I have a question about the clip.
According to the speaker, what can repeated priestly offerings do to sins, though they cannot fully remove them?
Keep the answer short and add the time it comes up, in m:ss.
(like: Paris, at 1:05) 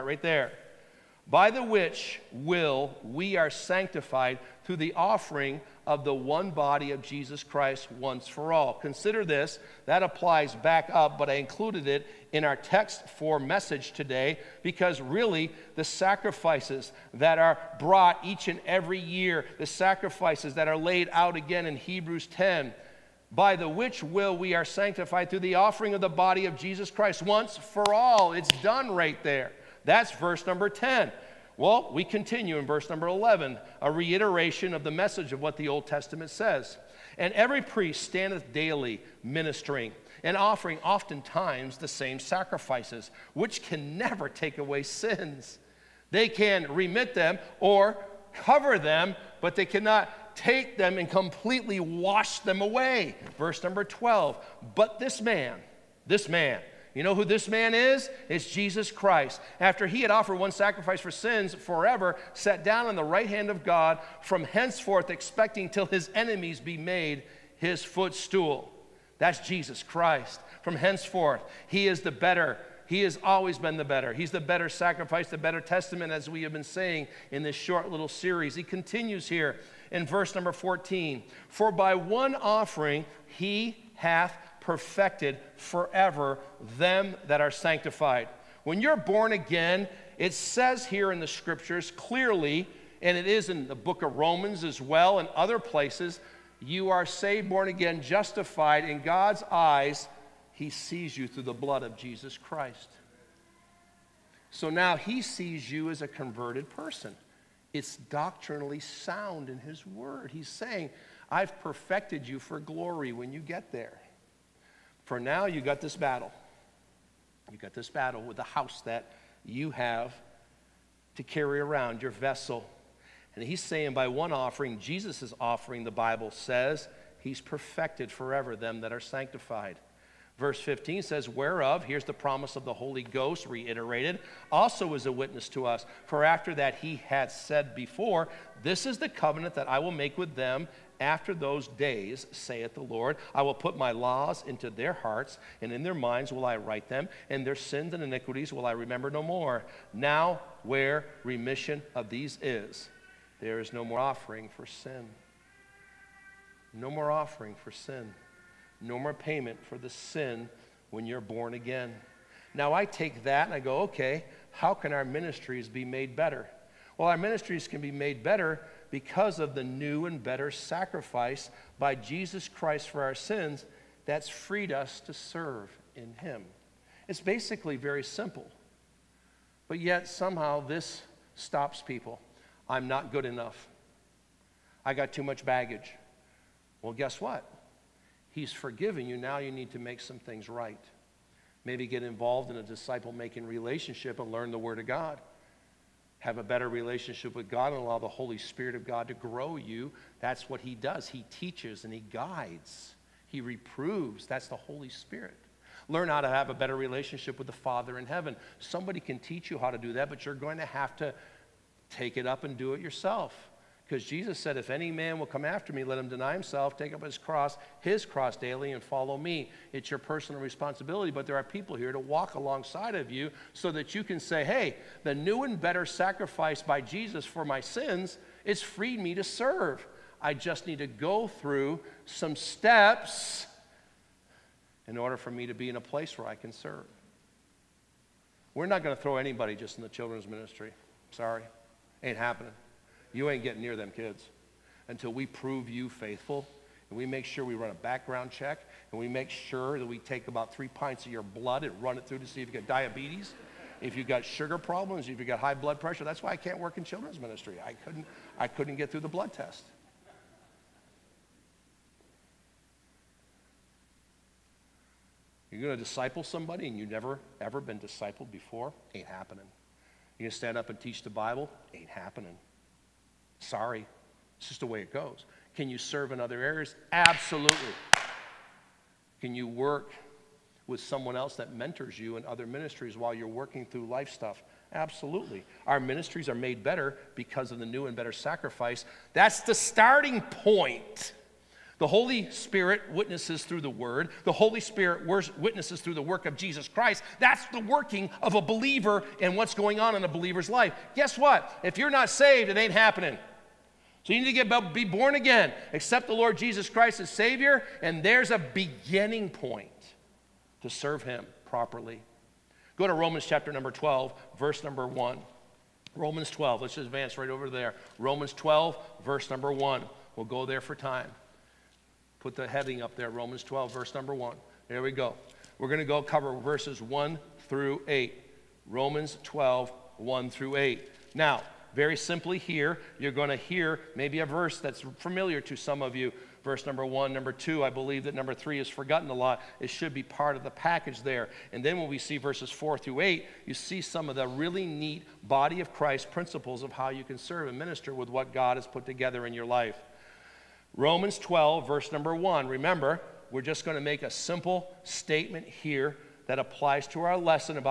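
remit them, at 0:46.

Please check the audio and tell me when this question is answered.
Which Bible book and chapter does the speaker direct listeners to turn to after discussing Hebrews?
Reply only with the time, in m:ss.
5:12.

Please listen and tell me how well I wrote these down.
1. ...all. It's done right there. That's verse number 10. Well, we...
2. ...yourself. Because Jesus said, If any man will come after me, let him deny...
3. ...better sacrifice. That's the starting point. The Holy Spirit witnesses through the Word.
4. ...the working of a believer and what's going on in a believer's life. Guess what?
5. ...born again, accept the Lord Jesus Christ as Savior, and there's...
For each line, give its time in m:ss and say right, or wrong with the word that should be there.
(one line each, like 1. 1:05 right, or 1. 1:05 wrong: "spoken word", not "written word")
1. 0:27 right
2. 3:32 right
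3. 4:47 right
4. 4:57 right
5. 5:04 right.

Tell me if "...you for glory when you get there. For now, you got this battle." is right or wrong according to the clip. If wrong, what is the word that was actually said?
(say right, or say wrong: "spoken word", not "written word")
right.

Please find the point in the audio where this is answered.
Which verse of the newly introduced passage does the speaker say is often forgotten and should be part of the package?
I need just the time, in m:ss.
5:38.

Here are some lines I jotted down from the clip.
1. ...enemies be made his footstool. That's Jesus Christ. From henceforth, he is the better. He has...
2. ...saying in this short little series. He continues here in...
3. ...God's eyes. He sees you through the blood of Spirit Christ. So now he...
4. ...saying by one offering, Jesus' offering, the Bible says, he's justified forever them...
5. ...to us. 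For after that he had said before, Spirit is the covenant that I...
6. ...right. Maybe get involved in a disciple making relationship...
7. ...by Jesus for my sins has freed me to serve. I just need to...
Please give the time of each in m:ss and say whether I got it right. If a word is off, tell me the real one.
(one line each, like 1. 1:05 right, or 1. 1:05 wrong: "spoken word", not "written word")
1. 1:06 right
2. 1:16 right
3. 1:39 wrong: "Jesus", not "Spirit"
4. 2:03 wrong: "perfected", not "justified"
5. 2:15 wrong: "This", not "Spirit"
6. 3:10 right
7. 3:46 right.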